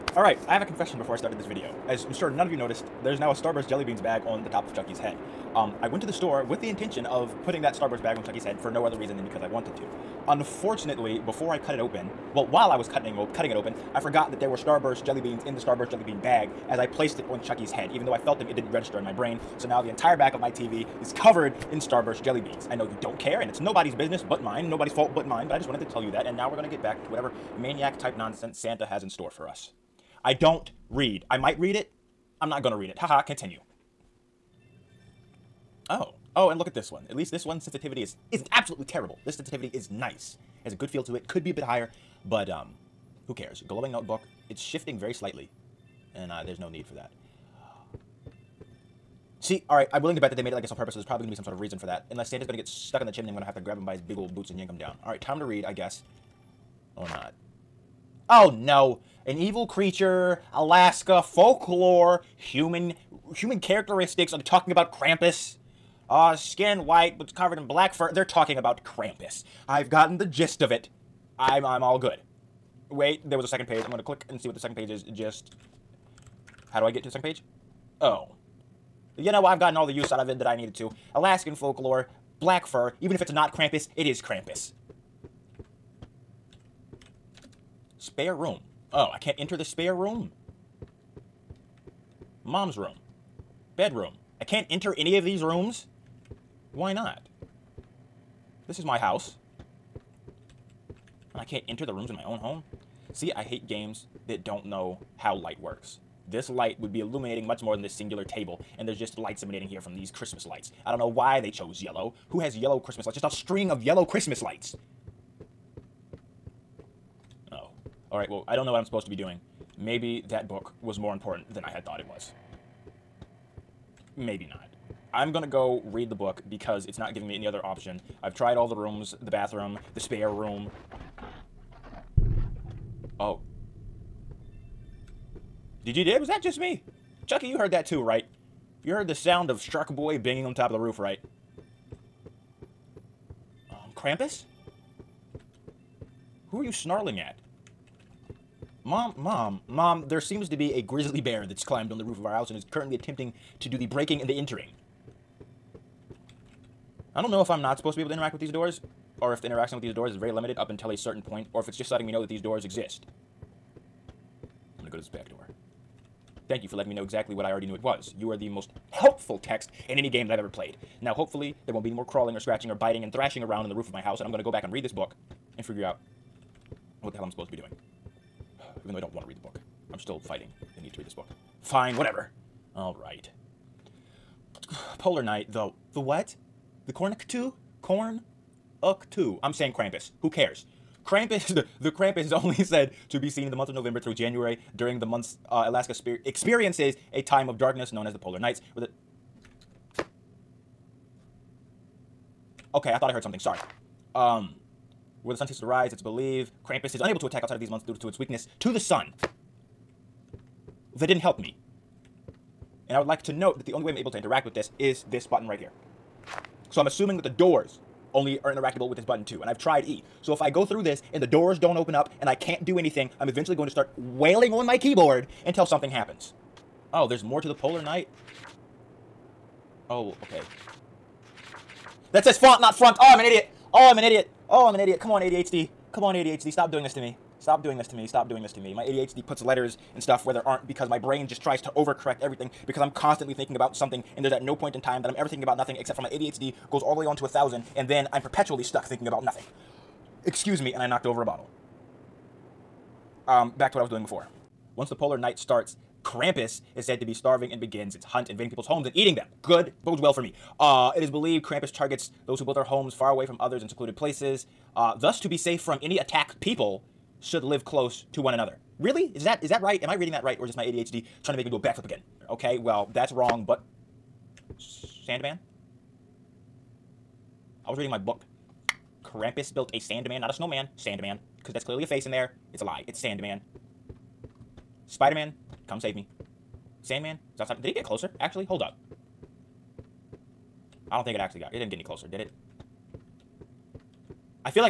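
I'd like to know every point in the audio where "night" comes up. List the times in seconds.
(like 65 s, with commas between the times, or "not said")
185 s, 198 s, 227 s, 255 s.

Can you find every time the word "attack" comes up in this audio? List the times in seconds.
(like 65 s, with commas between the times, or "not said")
207 s, 265 s.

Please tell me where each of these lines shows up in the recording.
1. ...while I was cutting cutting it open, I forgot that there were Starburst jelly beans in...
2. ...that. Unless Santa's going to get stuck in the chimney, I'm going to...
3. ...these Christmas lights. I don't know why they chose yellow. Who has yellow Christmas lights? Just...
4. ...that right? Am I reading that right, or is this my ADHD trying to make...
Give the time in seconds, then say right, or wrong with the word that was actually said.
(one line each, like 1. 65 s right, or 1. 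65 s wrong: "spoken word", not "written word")
1. 12 s right
2. 51 s right
3. 109 s right
4. 269 s right.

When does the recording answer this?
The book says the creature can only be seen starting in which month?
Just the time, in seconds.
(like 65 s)
193 s.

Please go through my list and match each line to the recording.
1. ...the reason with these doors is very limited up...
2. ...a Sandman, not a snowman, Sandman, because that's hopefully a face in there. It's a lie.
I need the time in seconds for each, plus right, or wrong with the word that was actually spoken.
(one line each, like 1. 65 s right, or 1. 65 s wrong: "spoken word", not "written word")
1. 159 s wrong: "interaction", not "reason"
2. 279 s wrong: "clearly", not "hopefully".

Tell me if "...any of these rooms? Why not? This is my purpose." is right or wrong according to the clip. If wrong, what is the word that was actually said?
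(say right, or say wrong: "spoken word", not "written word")
wrong: "house", not "purpose".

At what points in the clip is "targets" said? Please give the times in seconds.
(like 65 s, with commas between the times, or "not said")
261 s.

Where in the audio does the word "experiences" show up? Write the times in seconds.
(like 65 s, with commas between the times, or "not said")
196 s.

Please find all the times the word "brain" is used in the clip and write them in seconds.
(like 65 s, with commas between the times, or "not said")
19 s, 240 s.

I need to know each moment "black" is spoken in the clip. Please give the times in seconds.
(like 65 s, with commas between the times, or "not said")
67 s, 82 s.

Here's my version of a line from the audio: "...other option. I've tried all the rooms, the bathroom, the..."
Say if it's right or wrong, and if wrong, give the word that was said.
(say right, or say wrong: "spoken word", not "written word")
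right.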